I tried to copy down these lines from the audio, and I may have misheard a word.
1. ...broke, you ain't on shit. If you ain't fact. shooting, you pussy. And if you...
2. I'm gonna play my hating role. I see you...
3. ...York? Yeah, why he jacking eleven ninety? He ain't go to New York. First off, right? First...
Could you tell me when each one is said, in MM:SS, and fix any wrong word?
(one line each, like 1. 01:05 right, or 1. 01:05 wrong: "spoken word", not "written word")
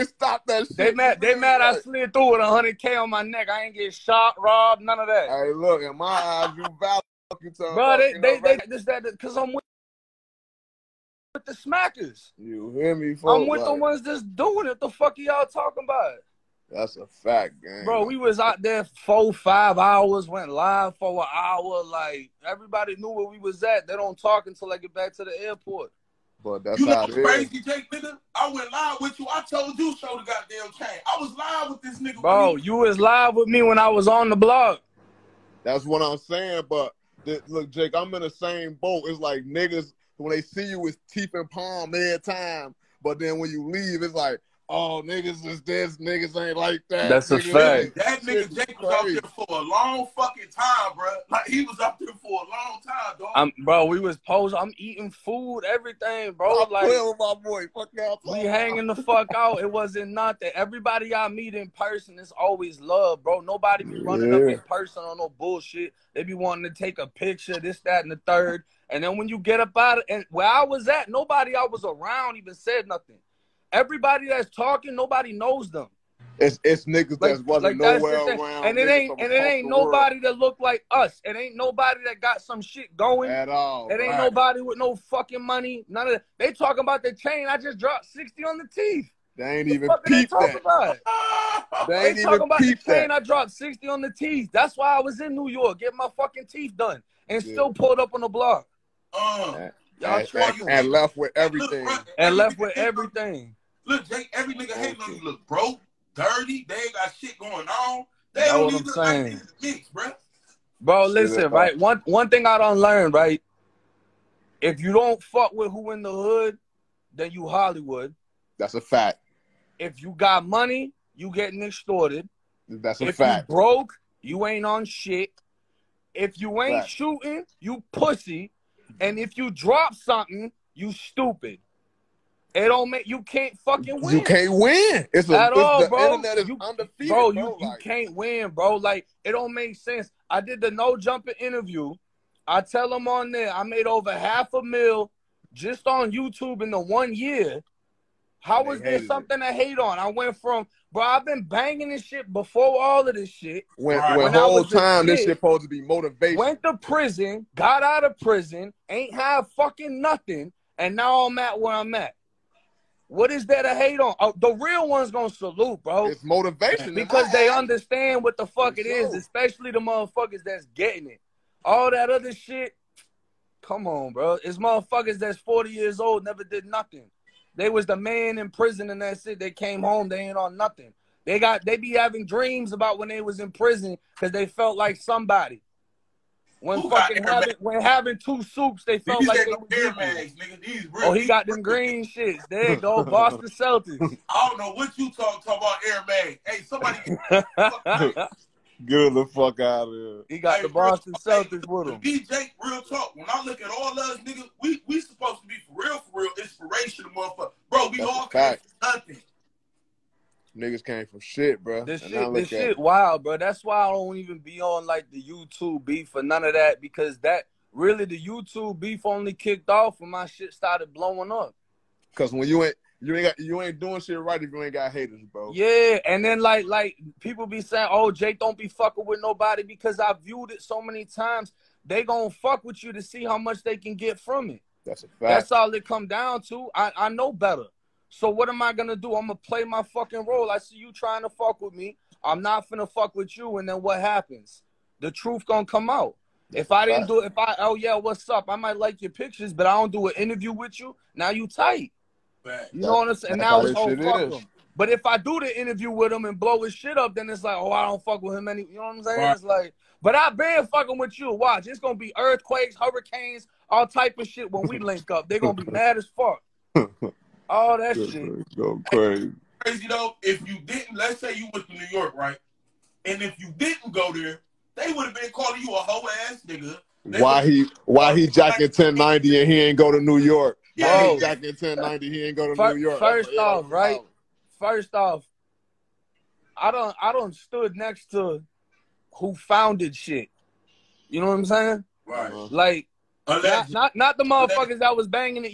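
1. 02:03 right
2. 03:59 wrong: "fucking", not "hating"
3. 04:40 wrong: "ten", not "eleven".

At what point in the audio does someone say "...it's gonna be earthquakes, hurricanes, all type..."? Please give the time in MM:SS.
04:21.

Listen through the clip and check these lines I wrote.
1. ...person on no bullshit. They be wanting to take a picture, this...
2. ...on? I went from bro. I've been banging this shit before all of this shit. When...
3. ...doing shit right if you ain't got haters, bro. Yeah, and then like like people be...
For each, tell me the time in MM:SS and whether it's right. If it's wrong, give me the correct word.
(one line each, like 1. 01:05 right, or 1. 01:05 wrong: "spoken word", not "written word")
1. 01:04 right
2. 02:29 right
3. 03:43 right.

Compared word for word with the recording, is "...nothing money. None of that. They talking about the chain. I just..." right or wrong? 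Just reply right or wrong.
wrong.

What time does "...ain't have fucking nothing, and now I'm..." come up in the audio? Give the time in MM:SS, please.
02:38.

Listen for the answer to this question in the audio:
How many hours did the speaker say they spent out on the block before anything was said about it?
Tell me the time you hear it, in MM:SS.
00:18.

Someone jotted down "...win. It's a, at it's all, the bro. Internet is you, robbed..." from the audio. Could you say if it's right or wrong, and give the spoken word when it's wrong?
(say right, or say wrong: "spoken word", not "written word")
wrong: "undefeated", not "robbed".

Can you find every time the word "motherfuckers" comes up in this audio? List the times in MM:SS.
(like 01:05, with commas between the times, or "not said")
02:49, 02:54, 03:27, 04:54.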